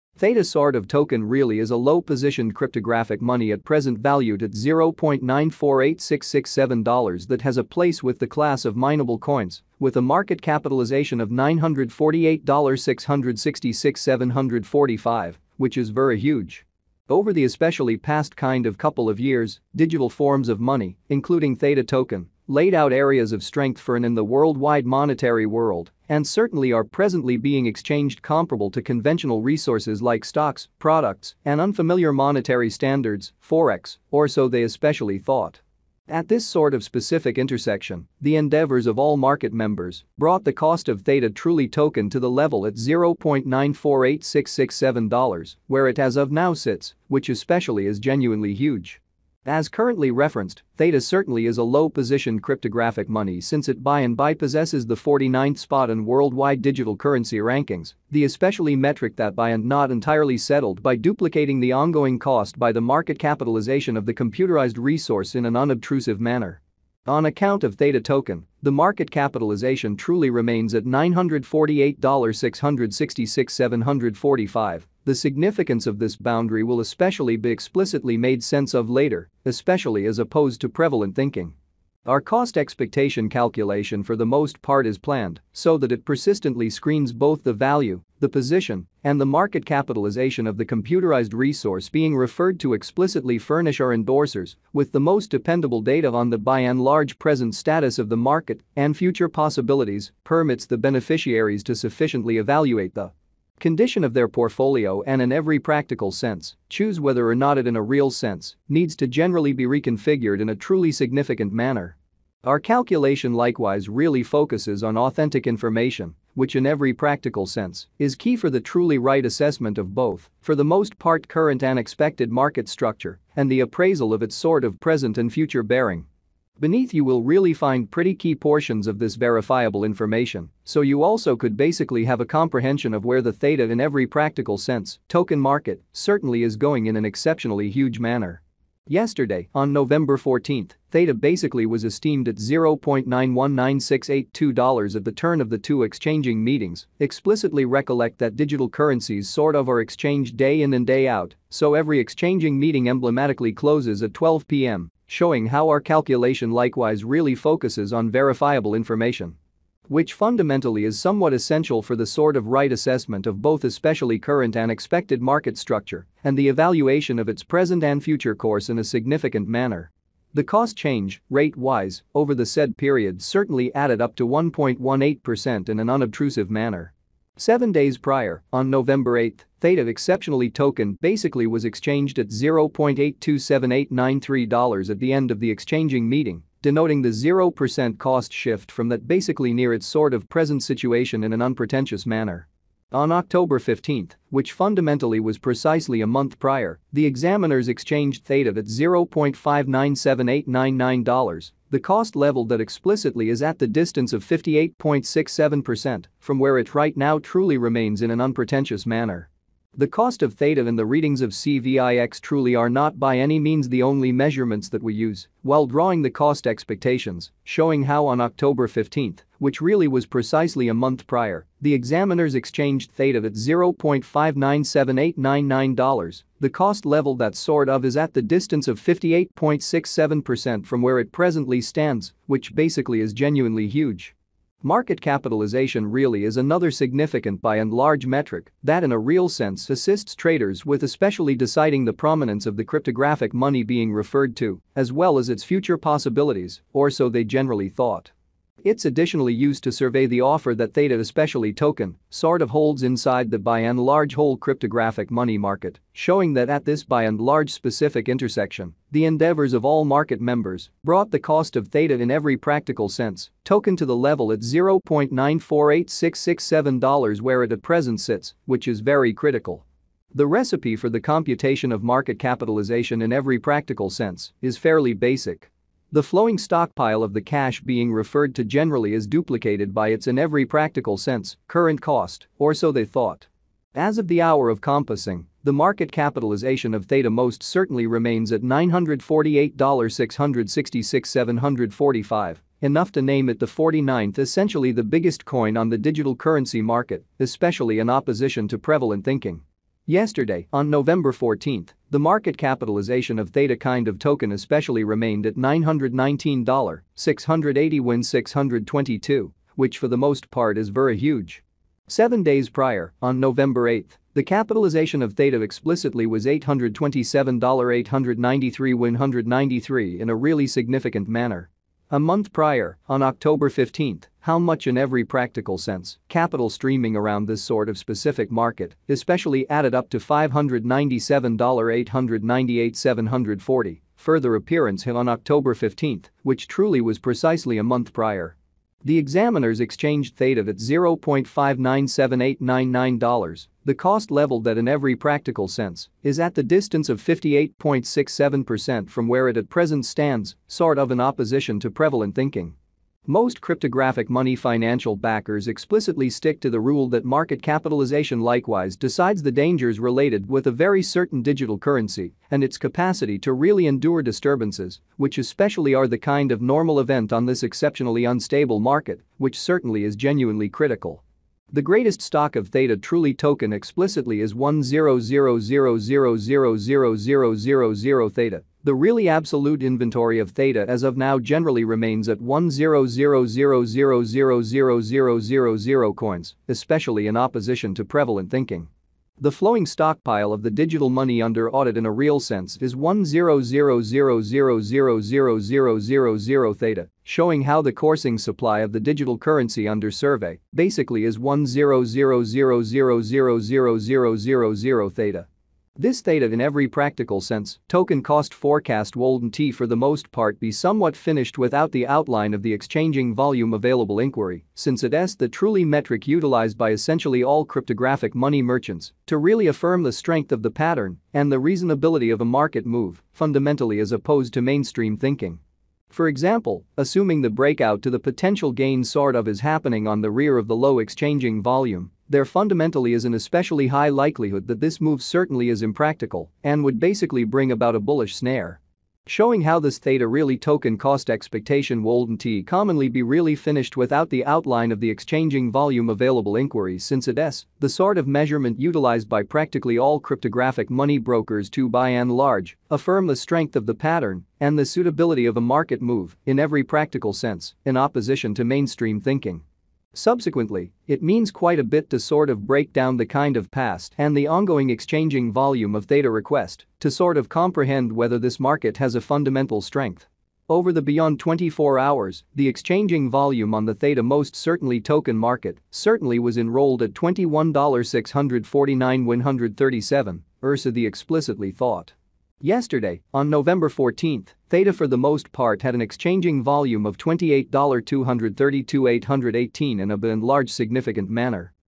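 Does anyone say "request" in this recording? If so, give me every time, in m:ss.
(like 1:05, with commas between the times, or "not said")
7:46.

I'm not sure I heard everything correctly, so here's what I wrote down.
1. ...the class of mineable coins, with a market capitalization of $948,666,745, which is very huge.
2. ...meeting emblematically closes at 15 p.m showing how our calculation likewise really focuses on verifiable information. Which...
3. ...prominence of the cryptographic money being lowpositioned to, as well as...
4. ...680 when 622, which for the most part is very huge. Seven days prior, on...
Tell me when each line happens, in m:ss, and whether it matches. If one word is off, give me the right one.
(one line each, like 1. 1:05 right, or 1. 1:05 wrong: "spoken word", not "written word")
1. 0:08 right
2. 2:32 wrong: "12", not "15"
3. 4:01 wrong: "referred", not "lowpositioned"
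4. 5:06 right.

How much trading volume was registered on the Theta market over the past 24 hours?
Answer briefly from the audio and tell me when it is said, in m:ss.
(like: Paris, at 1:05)
$21,649,137, at 7:56.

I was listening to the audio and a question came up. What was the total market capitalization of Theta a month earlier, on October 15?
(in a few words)
$597,898,740.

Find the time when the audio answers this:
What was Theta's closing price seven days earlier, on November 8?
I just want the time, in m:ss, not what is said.
3:02.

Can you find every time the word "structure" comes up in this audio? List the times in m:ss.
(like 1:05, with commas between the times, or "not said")
2:02, 2:45.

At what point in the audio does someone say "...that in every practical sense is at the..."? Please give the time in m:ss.
5:44.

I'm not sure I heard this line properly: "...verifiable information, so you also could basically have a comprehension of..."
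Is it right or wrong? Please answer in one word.
right.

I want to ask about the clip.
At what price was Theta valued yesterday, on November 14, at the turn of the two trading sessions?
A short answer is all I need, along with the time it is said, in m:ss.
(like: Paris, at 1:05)
$0.919682, at 2:22.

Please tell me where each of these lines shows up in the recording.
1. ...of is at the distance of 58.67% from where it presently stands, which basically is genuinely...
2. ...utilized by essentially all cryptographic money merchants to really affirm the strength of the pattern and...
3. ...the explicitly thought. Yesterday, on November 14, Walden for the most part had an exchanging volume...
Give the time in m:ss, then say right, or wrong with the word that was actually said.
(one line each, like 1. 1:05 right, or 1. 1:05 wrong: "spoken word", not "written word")
1. 3:47 right
2. 6:56 right
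3. 8:00 wrong: "Theta", not "Walden".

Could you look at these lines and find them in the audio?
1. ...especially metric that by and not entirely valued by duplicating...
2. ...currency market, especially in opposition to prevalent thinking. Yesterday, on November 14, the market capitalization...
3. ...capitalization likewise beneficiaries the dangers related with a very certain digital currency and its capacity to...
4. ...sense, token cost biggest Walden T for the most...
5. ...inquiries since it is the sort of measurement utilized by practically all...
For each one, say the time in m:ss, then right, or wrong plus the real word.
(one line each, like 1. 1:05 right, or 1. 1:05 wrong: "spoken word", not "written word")
1. 0:58 wrong: "settled", not "valued"
2. 4:56 right
3. 5:57 wrong: "decides", not "beneficiaries"
4. 6:47 wrong: "forecast", not "biggest"
5. 7:26 right.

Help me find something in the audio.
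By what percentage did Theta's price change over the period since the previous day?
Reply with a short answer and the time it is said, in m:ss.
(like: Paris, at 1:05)
1.18%, at 2:54.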